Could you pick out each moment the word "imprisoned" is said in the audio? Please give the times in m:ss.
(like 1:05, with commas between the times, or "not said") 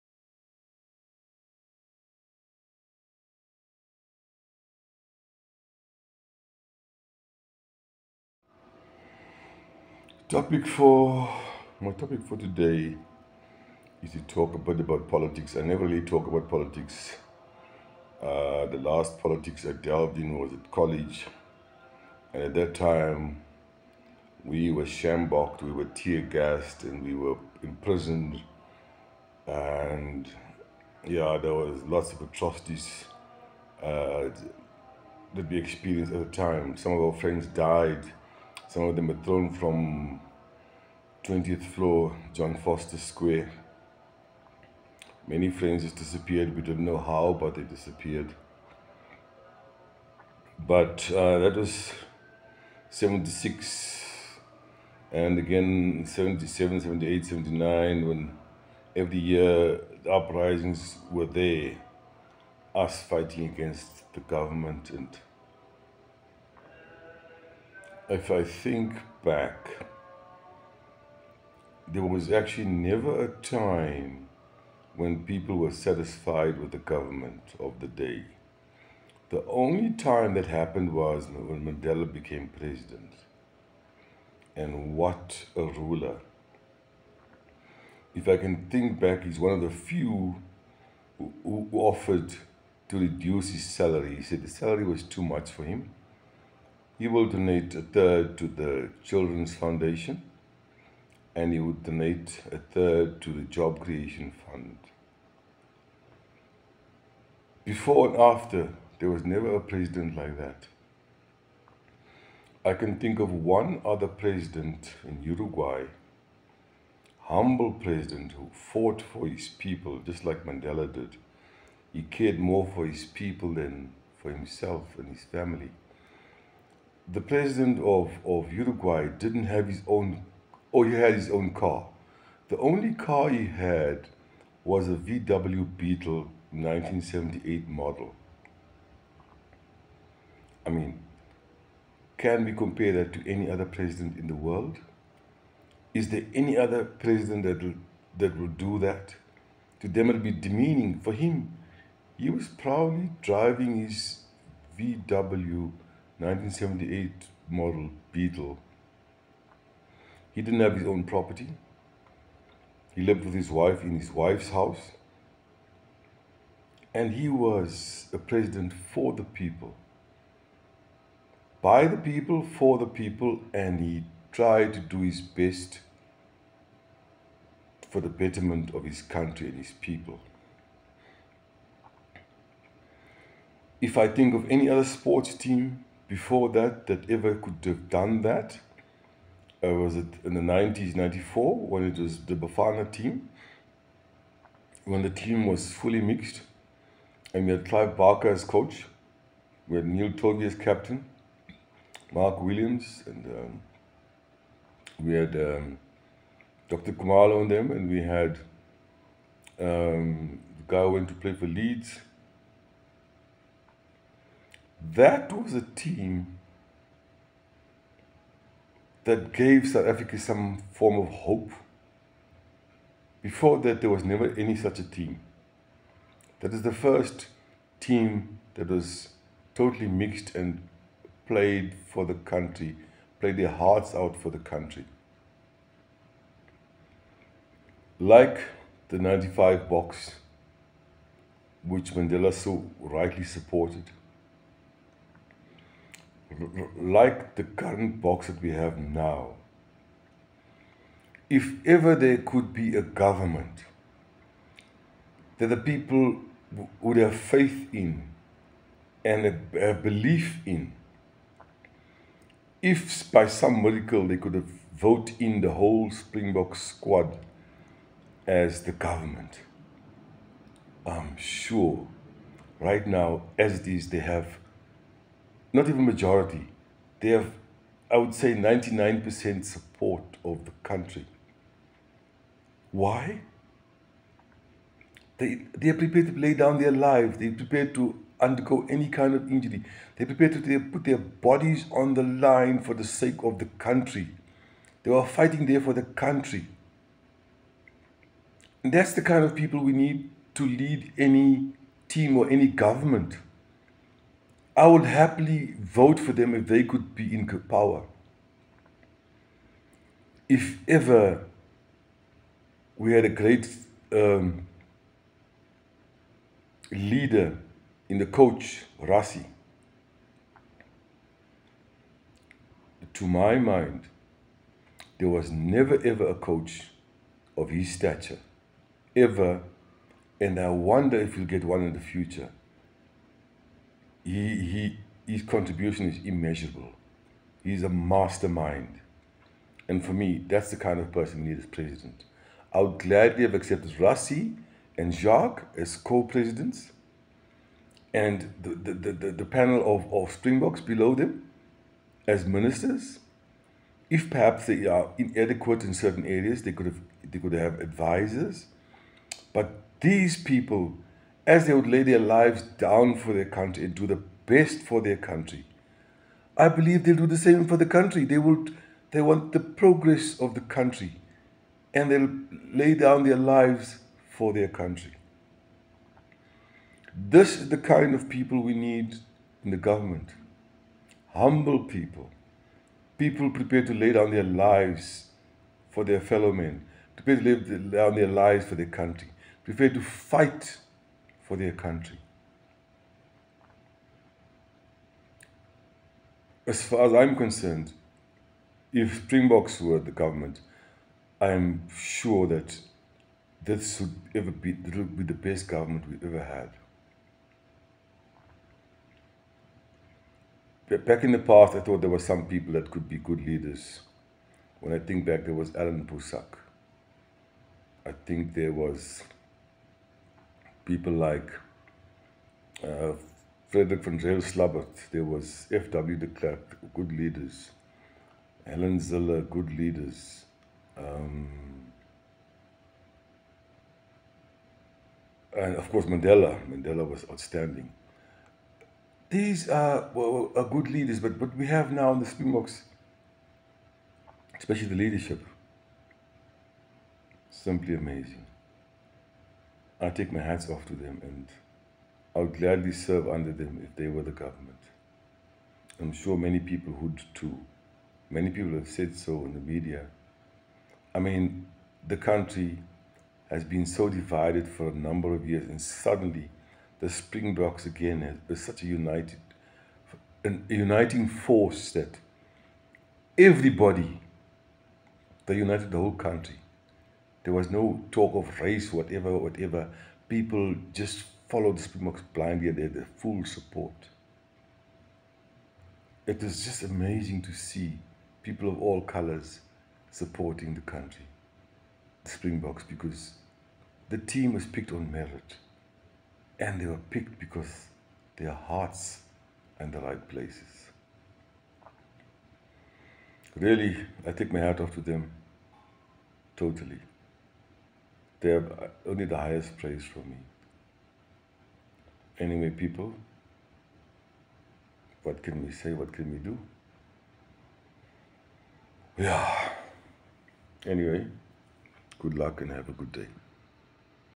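0:27.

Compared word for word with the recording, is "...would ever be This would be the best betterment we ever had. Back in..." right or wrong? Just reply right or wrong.
wrong.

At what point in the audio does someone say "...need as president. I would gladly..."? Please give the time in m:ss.
5:41.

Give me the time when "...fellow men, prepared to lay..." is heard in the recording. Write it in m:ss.
6:26.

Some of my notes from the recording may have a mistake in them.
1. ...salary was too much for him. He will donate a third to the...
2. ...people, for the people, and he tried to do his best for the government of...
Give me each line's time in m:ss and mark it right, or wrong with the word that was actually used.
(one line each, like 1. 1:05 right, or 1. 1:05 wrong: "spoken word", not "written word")
1. 1:34 right
2. 2:51 wrong: "betterment", not "government".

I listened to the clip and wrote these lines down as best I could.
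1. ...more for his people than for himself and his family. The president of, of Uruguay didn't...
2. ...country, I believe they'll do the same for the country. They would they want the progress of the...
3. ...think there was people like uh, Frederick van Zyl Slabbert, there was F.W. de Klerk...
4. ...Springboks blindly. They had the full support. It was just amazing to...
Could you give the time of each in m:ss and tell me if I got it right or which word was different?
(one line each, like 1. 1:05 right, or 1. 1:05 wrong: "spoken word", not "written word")
1. 2:02 right
2. 6:04 right
3. 6:58 right
4. 8:01 right.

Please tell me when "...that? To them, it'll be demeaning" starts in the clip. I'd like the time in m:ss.
2:28.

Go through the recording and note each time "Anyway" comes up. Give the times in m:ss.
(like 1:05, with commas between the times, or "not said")
8:32, 8:40.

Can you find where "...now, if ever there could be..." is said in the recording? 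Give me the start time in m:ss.
4:08.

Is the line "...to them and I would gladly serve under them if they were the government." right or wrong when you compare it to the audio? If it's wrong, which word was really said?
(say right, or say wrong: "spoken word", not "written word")
right.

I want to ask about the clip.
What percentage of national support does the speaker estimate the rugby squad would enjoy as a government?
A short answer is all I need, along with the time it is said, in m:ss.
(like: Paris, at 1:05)
99%, at 4:38.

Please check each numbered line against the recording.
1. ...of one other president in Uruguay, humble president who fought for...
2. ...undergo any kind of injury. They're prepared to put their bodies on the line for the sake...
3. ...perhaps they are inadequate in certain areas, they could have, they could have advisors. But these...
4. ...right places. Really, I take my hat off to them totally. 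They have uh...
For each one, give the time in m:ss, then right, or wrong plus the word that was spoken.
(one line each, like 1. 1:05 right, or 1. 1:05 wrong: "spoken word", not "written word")
1. 1:53 right
2. 4:48 right
3. 5:54 right
4. 8:19 right.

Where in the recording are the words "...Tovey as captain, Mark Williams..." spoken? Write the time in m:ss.
3:20.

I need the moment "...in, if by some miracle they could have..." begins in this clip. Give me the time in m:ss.
4:20.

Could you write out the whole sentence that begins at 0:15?
I never really talk about politics.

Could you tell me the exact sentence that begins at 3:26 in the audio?
Khumalo on them, and we had um, the guy who went to play for Leeds.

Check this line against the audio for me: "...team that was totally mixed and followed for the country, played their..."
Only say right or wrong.
wrong.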